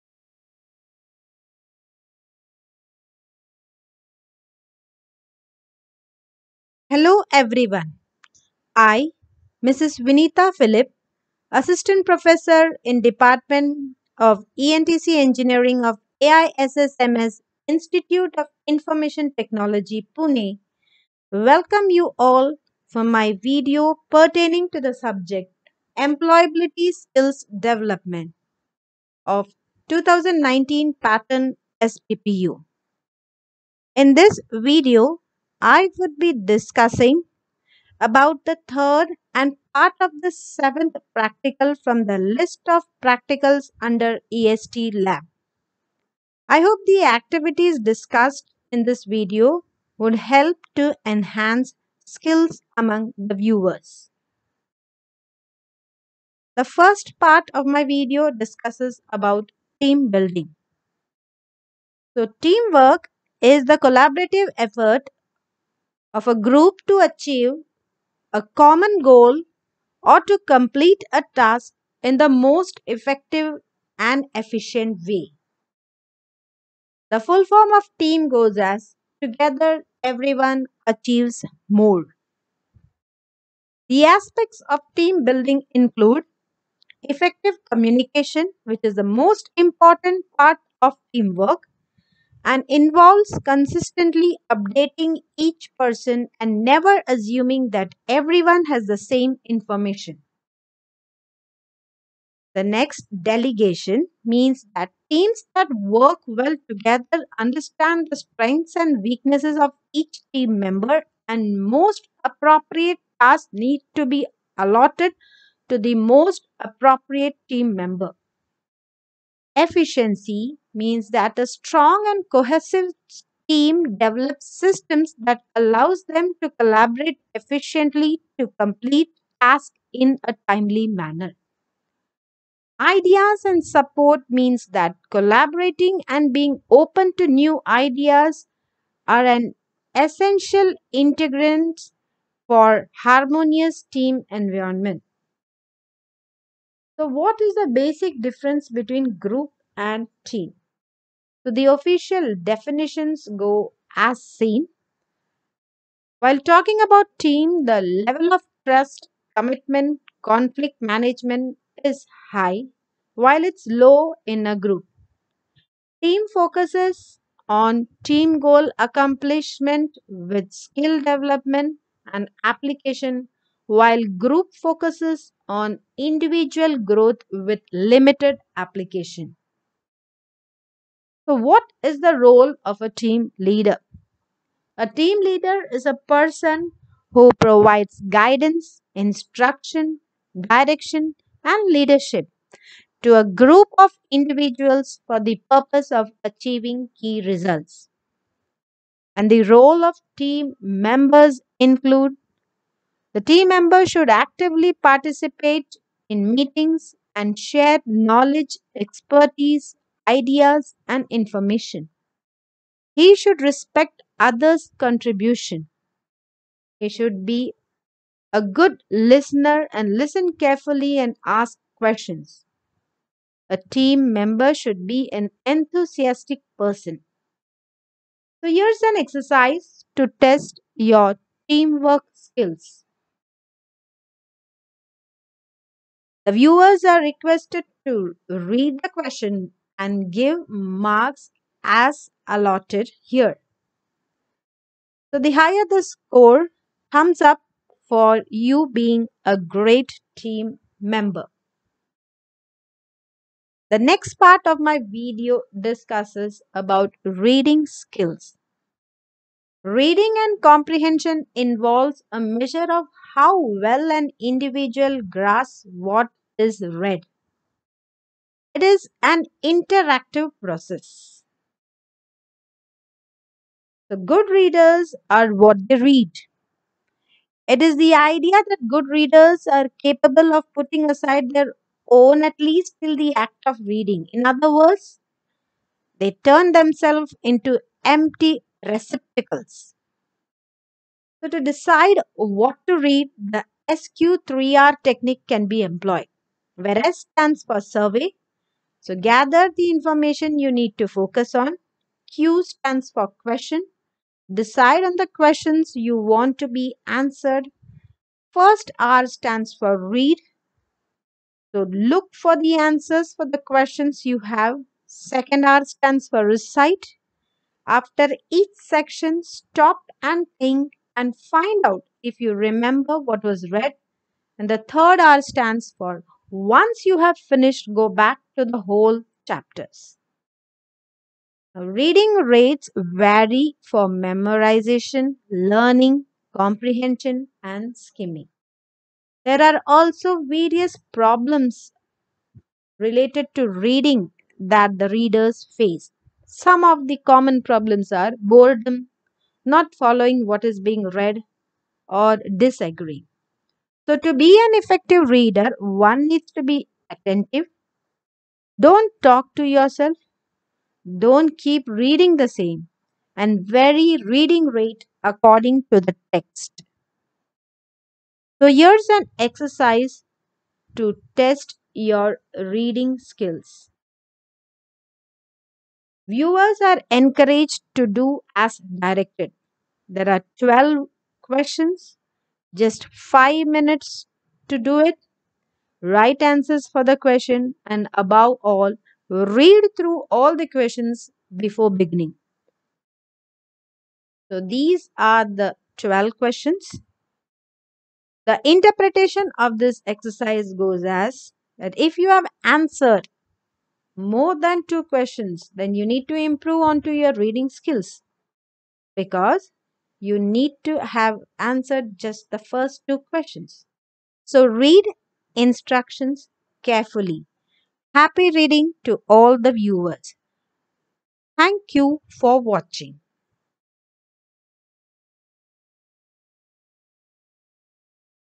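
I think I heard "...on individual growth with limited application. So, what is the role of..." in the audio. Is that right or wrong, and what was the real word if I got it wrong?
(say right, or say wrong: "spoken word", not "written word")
right.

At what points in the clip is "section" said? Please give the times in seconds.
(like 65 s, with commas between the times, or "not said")
318 s.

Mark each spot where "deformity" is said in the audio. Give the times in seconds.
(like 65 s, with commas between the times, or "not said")
not said.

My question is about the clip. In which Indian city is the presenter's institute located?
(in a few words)
Pune.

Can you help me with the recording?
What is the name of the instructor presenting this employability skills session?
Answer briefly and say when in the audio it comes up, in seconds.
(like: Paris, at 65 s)
Vineeta Philip, at 10 s.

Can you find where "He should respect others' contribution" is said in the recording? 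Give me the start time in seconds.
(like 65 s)
212 s.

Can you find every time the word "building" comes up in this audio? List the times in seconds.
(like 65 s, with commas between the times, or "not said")
60 s, 85 s.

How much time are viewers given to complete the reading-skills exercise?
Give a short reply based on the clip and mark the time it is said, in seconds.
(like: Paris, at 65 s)
5 minutes, at 382 s.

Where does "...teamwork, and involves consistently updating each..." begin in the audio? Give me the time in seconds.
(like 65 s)
91 s.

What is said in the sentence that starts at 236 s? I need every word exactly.
The viewers are requested to read the question and give marks as allotted here.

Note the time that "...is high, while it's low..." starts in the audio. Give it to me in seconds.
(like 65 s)
161 s.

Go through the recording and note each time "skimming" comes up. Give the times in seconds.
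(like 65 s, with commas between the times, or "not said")
337 s.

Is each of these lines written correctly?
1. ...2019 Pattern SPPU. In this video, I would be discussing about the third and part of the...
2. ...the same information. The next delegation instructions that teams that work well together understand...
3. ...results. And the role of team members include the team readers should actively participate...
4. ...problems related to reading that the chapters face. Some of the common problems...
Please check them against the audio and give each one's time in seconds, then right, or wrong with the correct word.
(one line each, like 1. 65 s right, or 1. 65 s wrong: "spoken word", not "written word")
1. 29 s right
2. 98 s wrong: "means", not "instructions"
3. 197 s wrong: "members", not "readers"
4. 340 s wrong: "readers", not "chapters".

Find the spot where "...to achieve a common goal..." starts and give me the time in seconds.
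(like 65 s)
66 s.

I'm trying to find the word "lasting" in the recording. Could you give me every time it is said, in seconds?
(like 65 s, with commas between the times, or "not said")
not said.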